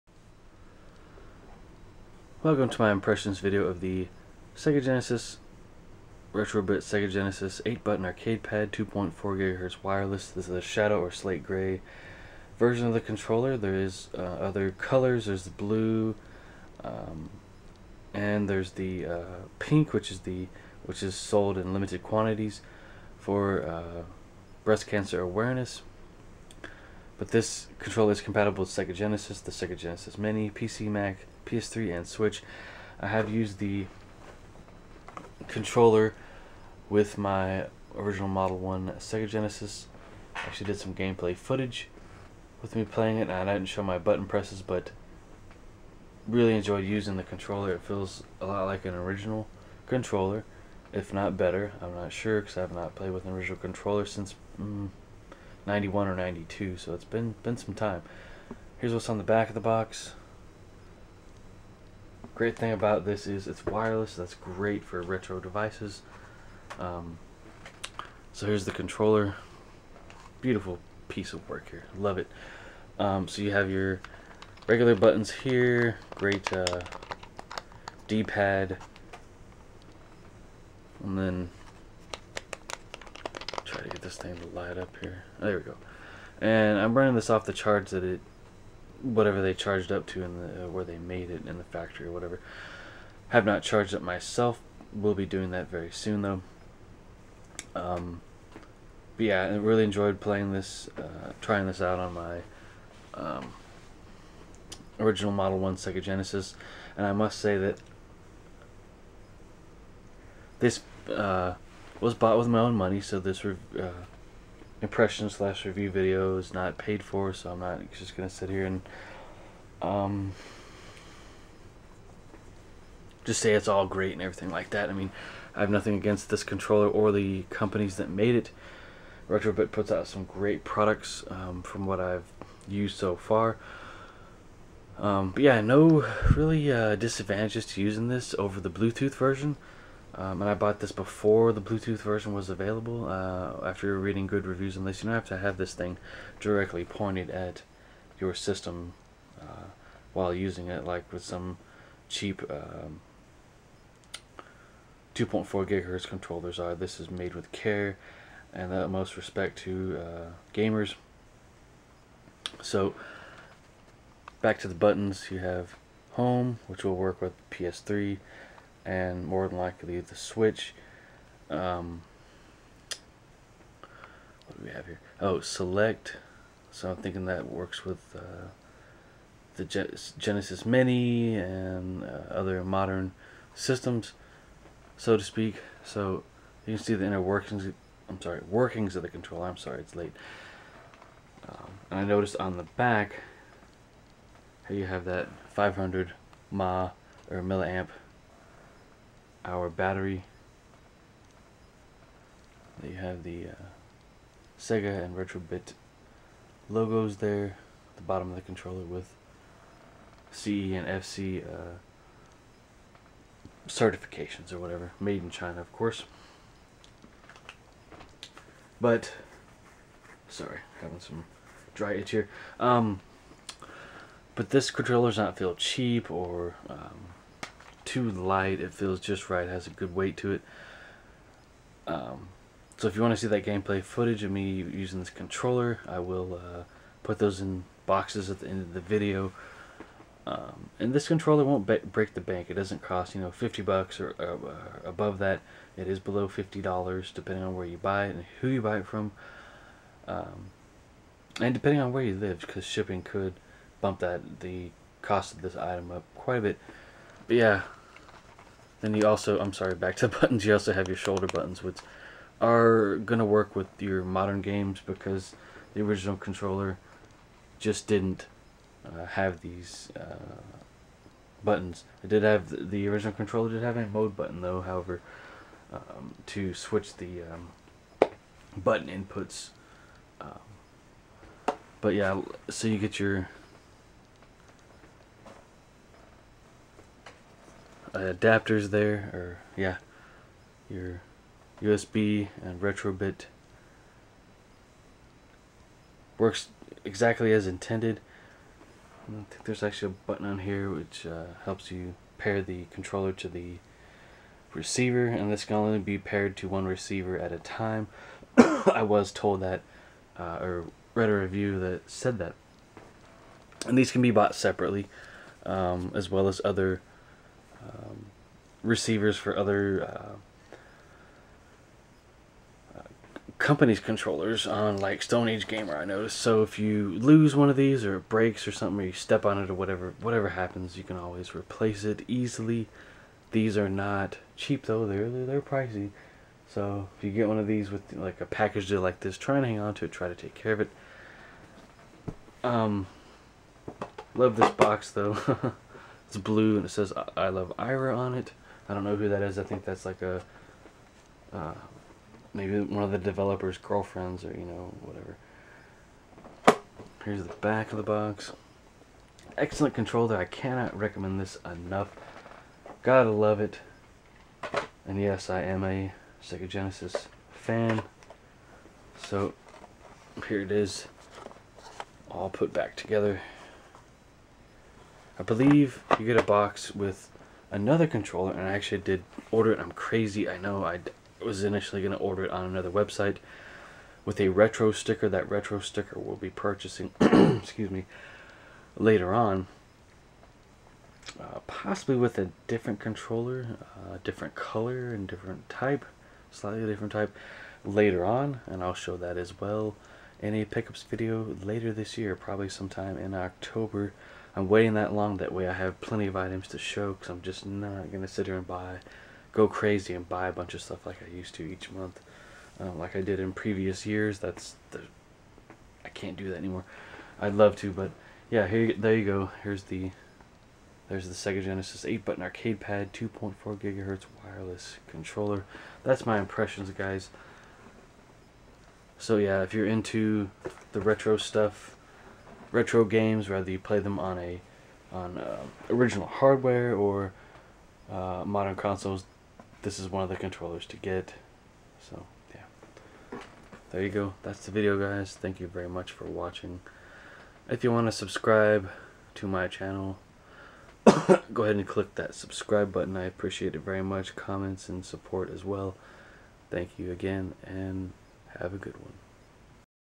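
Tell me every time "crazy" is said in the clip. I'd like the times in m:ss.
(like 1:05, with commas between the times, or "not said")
6:19, 6:49.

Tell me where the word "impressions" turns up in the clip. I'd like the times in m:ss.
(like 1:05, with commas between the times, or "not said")
0:02, 1:54, 7:06.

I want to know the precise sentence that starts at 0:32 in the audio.
I have used the controller with my original Model 1 Sega Genesis.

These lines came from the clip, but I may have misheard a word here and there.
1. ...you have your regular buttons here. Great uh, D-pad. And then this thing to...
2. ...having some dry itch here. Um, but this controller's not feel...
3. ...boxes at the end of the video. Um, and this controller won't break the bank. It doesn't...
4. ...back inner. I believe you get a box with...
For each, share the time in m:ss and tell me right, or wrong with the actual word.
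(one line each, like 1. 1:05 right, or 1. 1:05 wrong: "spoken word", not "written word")
1. 1:13 right
2. 3:40 right
3. 3:57 right
4. 6:12 wrong: "together", not "inner".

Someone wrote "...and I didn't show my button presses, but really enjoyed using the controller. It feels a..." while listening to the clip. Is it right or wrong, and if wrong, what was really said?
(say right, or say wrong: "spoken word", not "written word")
right.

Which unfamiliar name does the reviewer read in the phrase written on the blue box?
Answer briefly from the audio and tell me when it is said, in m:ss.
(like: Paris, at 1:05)
Ira, at 5:47.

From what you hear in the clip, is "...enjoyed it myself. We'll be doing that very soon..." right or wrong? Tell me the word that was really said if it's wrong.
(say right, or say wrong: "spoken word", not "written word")
wrong: "charged", not "enjoyed".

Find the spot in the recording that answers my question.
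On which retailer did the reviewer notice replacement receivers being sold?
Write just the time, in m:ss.
5:25.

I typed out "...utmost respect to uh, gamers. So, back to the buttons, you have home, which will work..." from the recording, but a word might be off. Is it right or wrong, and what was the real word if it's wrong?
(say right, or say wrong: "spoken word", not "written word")
right.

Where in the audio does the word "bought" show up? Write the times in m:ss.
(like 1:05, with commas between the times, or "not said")
1:52, 2:20, 5:14.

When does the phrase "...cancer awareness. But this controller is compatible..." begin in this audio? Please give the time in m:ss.
0:24.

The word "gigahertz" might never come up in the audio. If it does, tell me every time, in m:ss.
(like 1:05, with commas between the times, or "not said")
2:35, 7:03.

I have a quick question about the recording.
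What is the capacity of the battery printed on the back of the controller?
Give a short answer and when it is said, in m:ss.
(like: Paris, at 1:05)
500 mA, at 3:15.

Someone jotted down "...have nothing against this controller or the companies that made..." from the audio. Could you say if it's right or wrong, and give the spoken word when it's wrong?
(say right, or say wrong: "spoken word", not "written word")
right.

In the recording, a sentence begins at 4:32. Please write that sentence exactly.
It did have, the, the original controller did have a mode button though, however, um, to switch the um, button inputs.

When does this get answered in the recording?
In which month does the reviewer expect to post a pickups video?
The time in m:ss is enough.
6:43.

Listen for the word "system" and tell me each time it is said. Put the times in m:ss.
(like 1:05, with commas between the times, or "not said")
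2:28, 3:03.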